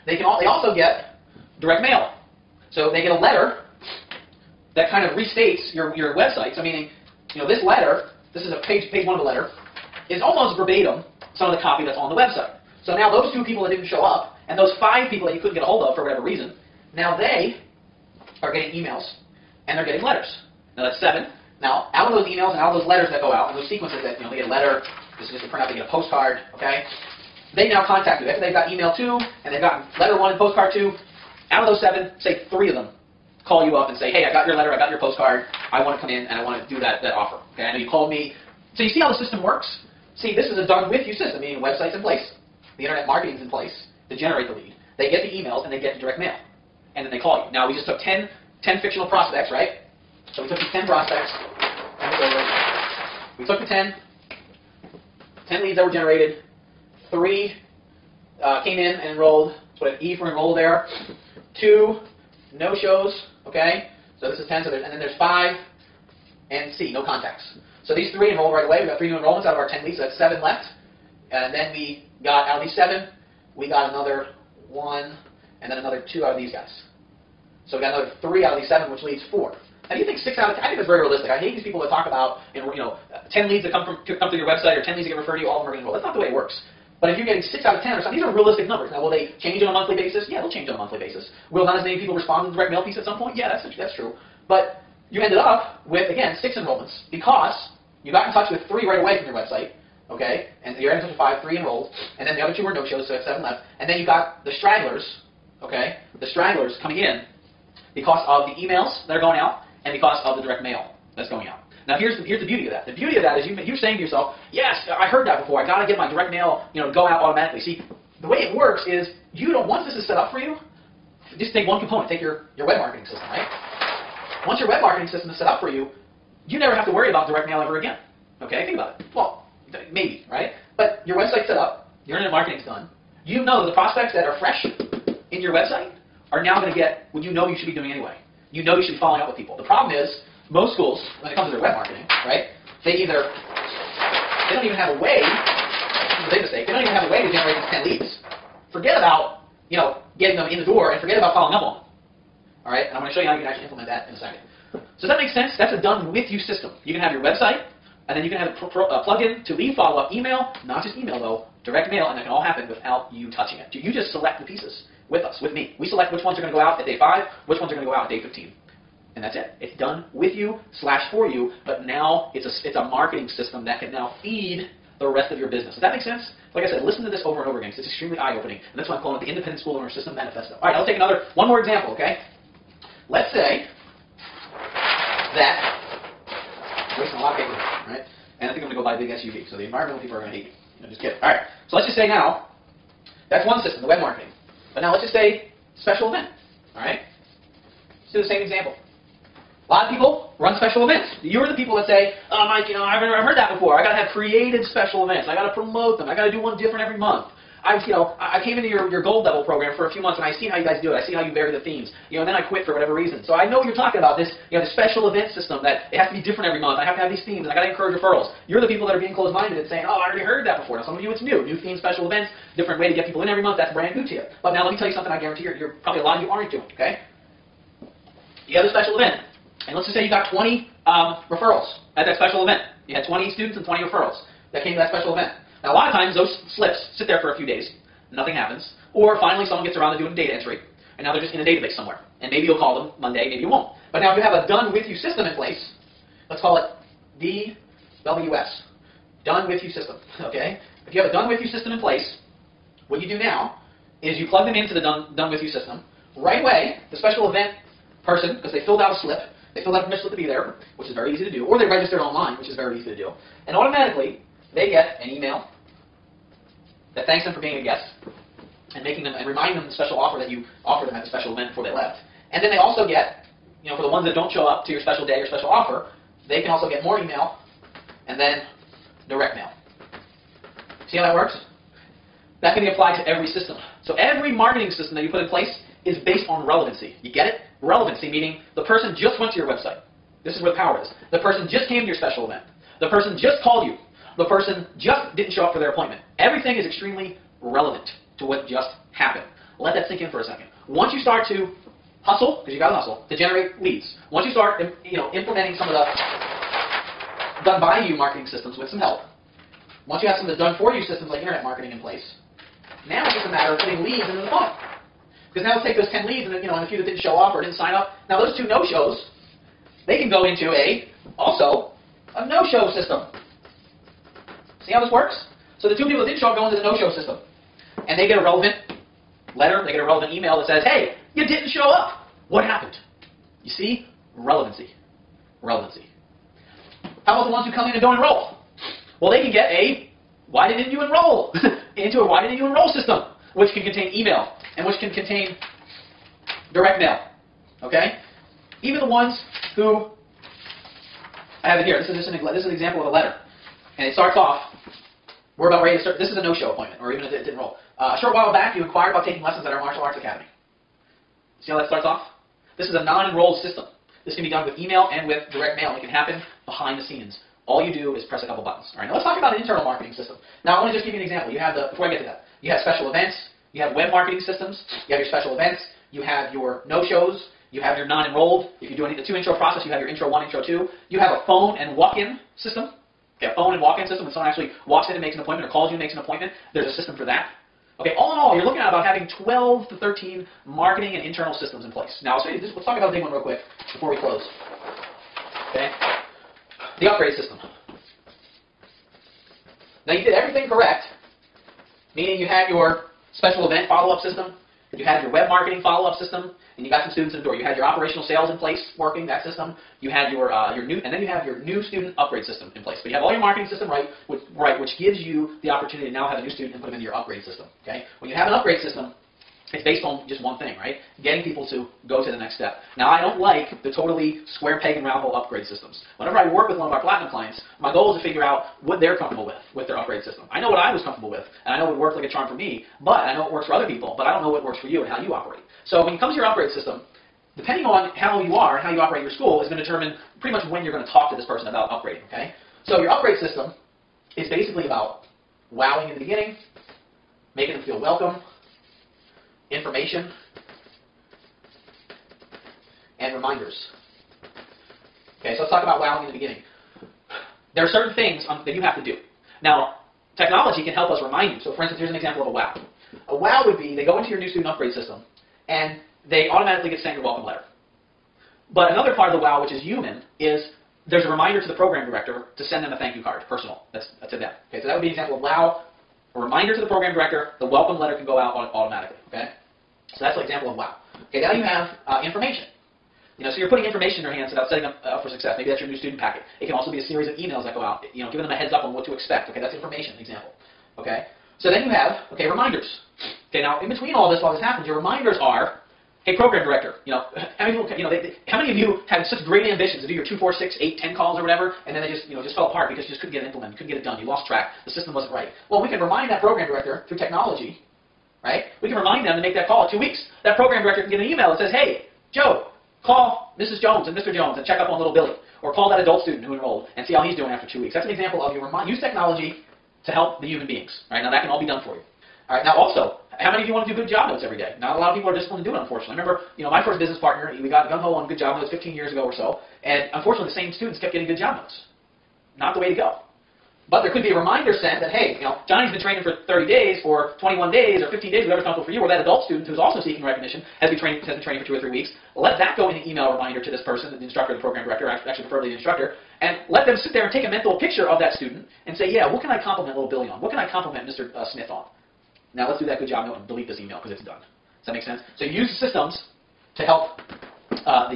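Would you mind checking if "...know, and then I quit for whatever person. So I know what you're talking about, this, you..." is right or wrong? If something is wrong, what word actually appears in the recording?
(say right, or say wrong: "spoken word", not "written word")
wrong: "reason", not "person".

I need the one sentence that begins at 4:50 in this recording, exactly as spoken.
This is where the power is.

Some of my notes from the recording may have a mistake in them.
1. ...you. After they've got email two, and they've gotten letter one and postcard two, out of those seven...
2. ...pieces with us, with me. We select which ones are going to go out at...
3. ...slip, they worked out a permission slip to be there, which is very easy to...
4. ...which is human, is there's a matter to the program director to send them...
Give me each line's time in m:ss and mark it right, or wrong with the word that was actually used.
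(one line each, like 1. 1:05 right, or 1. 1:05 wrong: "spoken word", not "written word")
1. 0:28 right
2. 2:44 right
3. 4:19 wrong: "filled", not "worked"
4. 7:49 wrong: "reminder", not "matter".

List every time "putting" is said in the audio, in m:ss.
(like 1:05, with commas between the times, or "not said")
5:13, 8:03.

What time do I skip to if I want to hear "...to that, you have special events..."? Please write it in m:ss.
6:11.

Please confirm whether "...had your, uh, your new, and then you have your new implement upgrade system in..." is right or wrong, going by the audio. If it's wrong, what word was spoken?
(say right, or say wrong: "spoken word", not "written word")
wrong: "student", not "implement".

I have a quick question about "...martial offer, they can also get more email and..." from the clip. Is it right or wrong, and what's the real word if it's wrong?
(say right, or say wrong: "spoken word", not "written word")
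wrong: "special", not "martial".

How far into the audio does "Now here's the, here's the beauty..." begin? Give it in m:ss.
1:51.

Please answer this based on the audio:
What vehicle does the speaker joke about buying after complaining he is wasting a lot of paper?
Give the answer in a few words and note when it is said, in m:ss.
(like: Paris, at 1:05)
SUV, at 3:08.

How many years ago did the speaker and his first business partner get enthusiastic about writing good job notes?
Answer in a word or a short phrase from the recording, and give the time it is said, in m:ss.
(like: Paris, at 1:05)
15, at 8:48.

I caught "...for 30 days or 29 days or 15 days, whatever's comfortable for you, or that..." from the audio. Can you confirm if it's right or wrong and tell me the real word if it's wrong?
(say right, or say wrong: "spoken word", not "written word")
wrong: "21", not "29".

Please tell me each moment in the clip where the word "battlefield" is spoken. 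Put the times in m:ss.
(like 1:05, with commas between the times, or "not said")
not said.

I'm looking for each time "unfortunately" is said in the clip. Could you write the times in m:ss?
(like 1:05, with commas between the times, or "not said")
8:45, 8:49.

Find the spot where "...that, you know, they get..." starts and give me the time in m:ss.
0:24.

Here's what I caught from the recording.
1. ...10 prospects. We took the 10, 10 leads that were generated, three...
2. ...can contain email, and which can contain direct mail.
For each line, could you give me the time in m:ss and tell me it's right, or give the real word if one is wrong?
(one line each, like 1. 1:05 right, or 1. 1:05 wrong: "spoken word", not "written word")
1. 0:50 right
2. 5:43 right.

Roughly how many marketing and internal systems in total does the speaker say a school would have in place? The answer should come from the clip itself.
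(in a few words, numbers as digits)
12 to 13.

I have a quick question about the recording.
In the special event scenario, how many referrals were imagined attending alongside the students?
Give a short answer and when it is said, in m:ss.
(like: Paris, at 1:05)
20, at 3:50.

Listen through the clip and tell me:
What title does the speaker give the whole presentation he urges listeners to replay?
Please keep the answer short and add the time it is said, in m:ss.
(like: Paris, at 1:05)
Independent School Owner System Manifesto, at 2:59.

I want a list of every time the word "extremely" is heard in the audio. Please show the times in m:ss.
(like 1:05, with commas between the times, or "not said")
2:57, 4:56.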